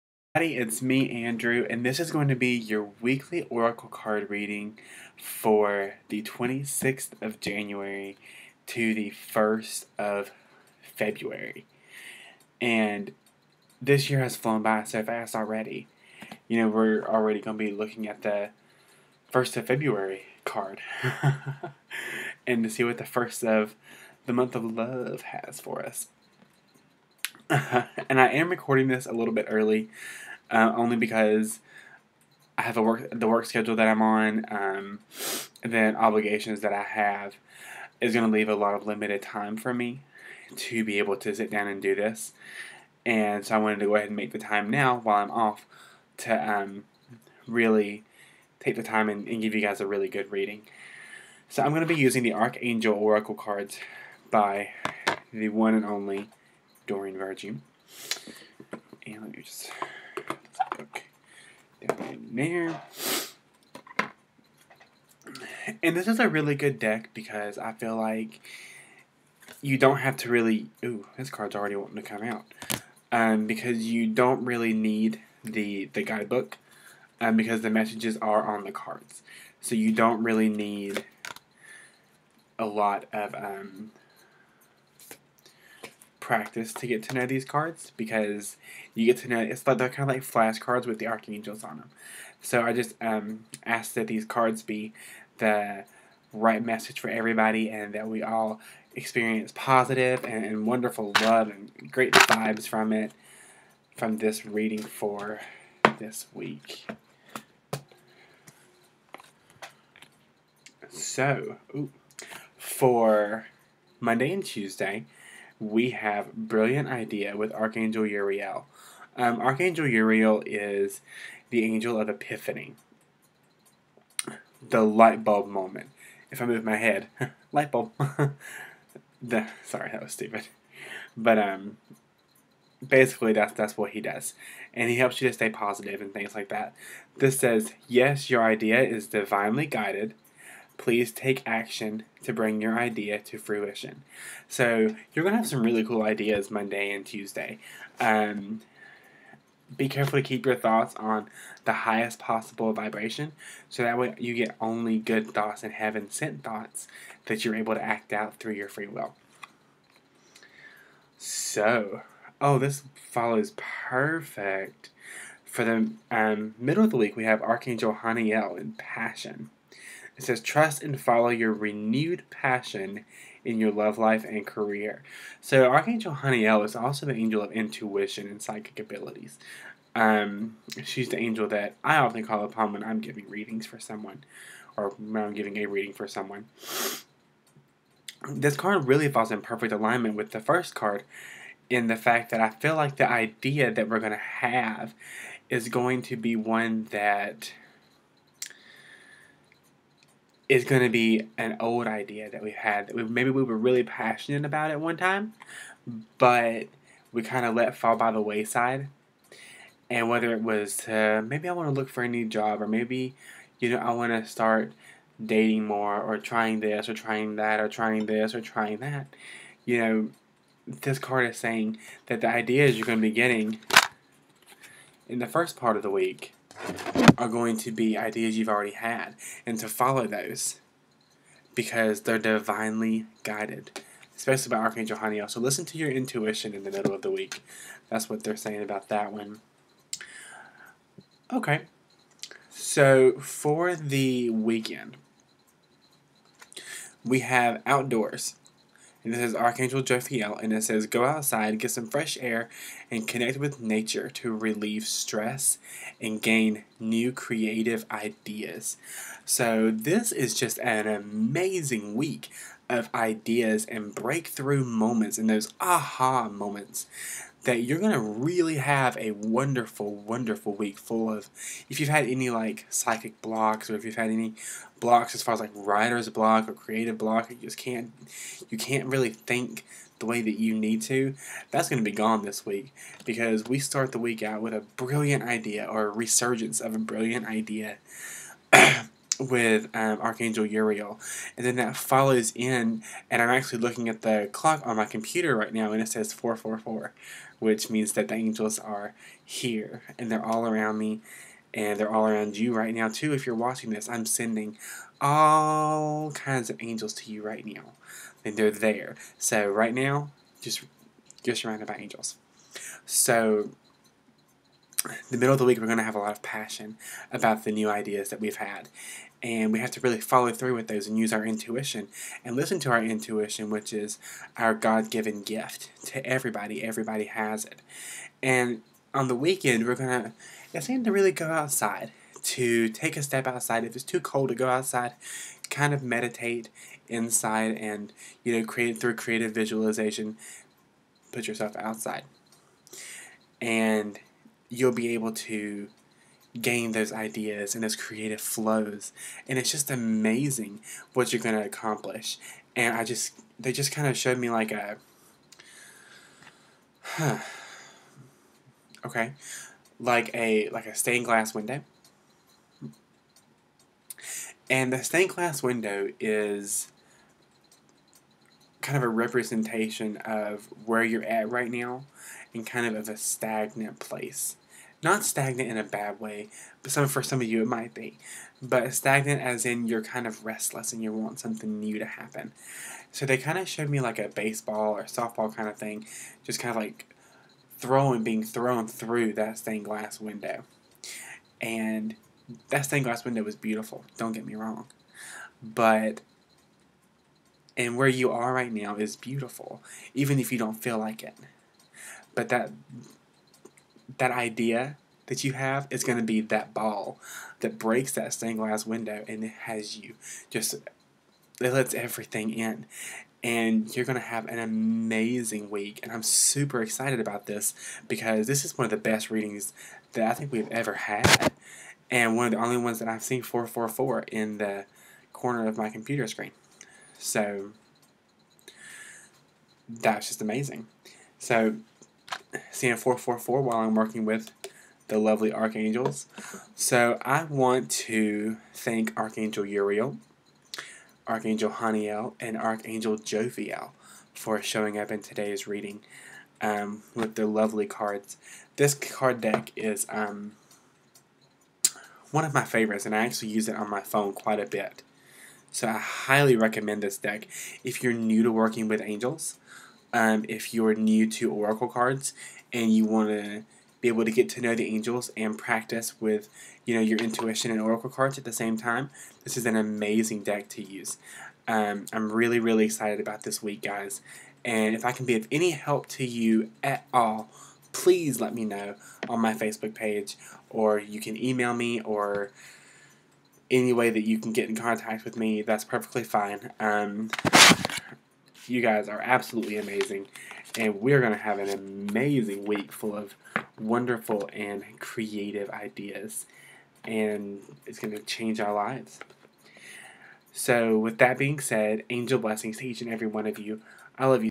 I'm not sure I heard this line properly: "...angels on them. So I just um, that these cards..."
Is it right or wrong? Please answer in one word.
wrong.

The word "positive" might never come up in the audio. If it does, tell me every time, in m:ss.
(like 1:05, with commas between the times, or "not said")
1:39, 2:15.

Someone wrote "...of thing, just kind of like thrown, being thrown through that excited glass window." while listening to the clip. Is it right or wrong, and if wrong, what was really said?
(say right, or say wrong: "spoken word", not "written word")
wrong: "stained", not "excited".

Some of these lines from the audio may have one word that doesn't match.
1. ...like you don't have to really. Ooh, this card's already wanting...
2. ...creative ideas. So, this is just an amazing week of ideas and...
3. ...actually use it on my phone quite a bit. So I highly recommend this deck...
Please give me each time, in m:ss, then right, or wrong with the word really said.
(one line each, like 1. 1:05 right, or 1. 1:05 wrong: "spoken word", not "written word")
1. 1:07 right
2. 4:17 right
3. 7:33 right.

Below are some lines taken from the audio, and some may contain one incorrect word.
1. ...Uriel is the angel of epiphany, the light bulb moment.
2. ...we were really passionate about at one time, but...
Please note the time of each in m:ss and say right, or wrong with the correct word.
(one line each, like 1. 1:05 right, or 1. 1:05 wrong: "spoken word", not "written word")
1. 1:59 right
2. 3:23 right.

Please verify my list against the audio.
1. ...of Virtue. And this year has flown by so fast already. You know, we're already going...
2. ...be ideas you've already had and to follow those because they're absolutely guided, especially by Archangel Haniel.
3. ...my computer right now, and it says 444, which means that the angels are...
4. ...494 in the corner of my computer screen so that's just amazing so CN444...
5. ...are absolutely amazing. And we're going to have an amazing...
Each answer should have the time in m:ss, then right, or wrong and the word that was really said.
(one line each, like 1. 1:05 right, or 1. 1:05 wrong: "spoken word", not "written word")
1. 0:09 wrong: "February", not "Virtue"
2. 3:47 wrong: "divinely", not "absolutely"
3. 4:54 right
4. 7:03 wrong: "444", not "494"
5. 8:08 right.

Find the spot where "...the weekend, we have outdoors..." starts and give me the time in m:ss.
4:03.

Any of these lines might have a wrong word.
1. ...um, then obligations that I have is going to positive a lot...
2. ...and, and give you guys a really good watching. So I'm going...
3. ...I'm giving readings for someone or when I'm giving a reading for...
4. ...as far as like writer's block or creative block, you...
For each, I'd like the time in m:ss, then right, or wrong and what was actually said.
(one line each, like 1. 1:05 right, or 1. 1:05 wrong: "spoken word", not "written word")
1. 0:34 wrong: "leave", not "positive"
2. 0:49 wrong: "reading", not "watching"
3. 3:02 right
4. 4:35 right.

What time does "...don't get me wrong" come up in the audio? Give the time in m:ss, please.
6:33.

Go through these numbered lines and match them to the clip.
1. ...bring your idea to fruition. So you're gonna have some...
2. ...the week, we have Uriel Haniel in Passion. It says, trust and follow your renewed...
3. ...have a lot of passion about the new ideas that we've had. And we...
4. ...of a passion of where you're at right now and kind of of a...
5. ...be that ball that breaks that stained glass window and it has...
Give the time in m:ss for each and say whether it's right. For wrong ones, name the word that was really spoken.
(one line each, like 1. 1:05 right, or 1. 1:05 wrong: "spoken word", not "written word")
1. 2:22 right
2. 2:46 wrong: "Archangel", not "Uriel"
3. 5:15 right
4. 6:08 wrong: "representation", not "passion"
5. 6:46 right.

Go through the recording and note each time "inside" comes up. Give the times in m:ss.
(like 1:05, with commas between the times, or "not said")
5:36.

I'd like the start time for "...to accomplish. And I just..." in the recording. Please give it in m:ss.
5:51.